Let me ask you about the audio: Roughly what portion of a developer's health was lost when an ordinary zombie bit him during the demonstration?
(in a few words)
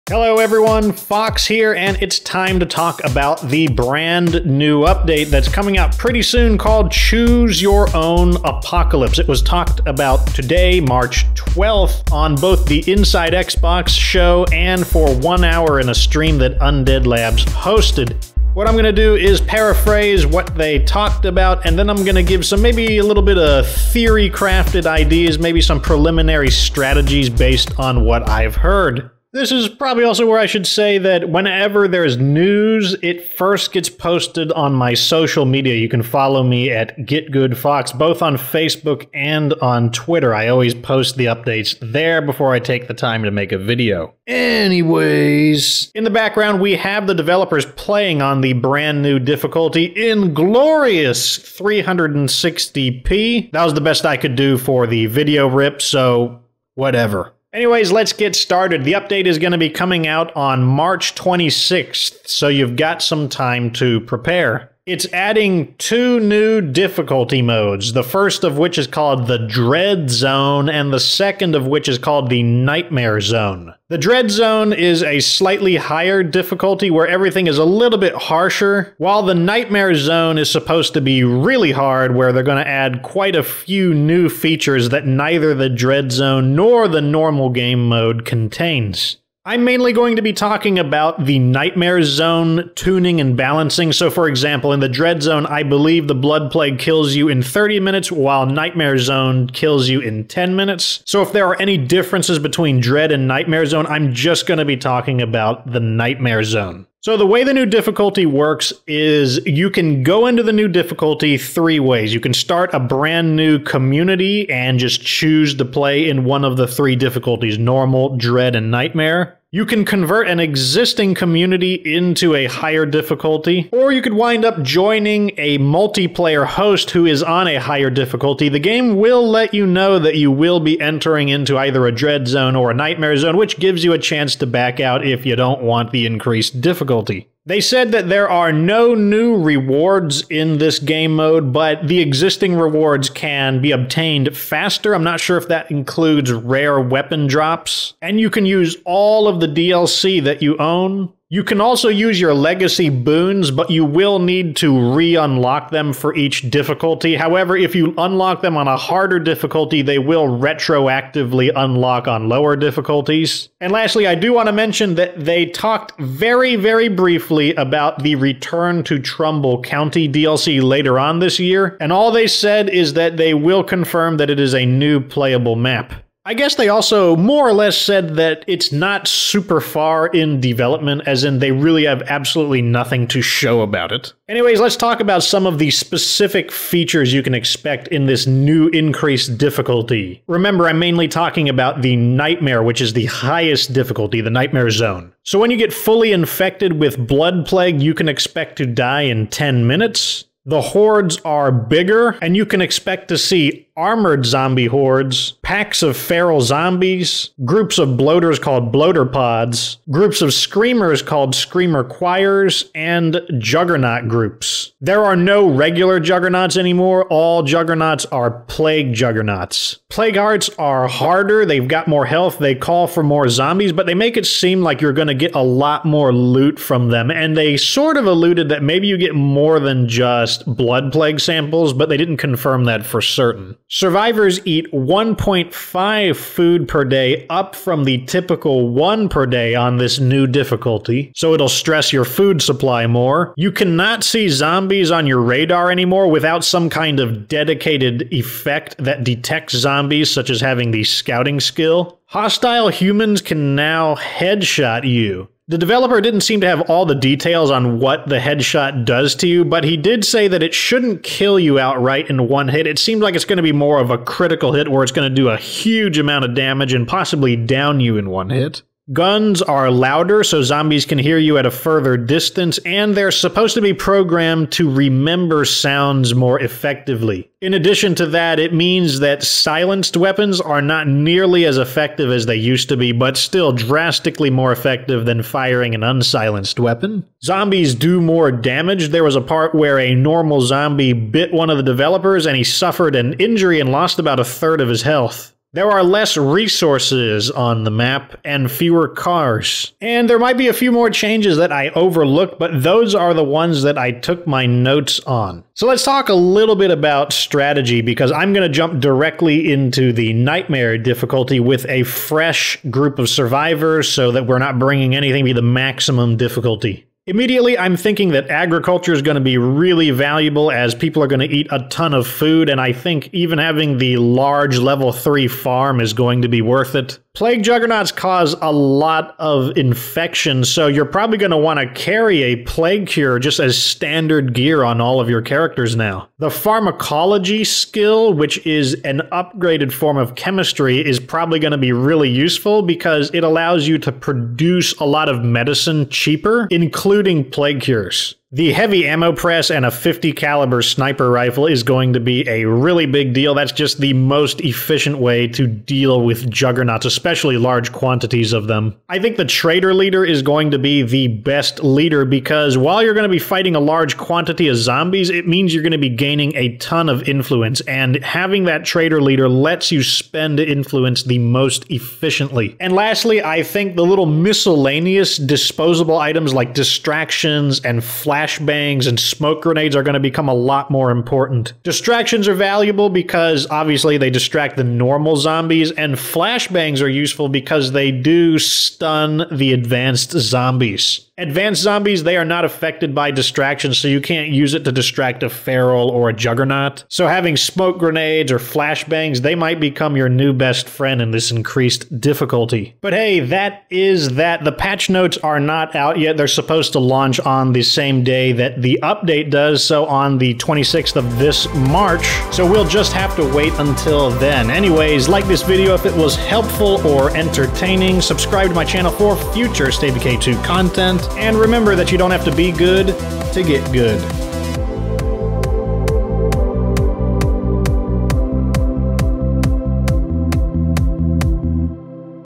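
a third.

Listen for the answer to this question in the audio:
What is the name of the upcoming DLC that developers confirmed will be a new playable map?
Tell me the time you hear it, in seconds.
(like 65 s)
168 s.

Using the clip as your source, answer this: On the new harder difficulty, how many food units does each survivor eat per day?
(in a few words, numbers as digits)
1.5.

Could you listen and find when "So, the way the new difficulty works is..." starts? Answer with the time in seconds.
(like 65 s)
107 s.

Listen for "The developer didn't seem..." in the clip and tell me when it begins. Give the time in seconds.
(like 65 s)
255 s.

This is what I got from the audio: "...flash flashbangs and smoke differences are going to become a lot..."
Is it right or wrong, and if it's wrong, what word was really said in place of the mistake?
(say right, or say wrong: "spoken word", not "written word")
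wrong: "grenades", not "differences".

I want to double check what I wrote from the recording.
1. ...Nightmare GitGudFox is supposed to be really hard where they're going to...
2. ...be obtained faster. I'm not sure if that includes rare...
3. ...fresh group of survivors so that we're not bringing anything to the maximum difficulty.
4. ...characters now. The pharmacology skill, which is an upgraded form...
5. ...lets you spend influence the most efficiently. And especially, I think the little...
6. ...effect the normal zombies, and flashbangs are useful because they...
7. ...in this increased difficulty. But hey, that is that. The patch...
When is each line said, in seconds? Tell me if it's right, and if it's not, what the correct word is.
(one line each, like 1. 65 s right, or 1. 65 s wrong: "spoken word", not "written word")
1. 79 s wrong: "Zone", not "GitGudFox"
2. 143 s right
3. 311 s right
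4. 335 s right
5. 369 s wrong: "lastly", not "especially"
6. 384 s wrong: "distract", not "effect"
7. 400 s right.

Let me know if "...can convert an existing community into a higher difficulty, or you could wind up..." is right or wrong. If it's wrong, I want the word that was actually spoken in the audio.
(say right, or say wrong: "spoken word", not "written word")
right.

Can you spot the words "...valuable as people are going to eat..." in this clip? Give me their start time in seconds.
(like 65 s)
319 s.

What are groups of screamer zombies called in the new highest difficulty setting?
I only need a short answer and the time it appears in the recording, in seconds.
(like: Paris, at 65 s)
screamer choirs, at 211 s.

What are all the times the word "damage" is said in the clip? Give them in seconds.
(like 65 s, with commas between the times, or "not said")
266 s, 288 s.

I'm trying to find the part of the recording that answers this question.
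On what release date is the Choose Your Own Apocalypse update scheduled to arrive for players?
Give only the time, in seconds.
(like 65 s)
60 s.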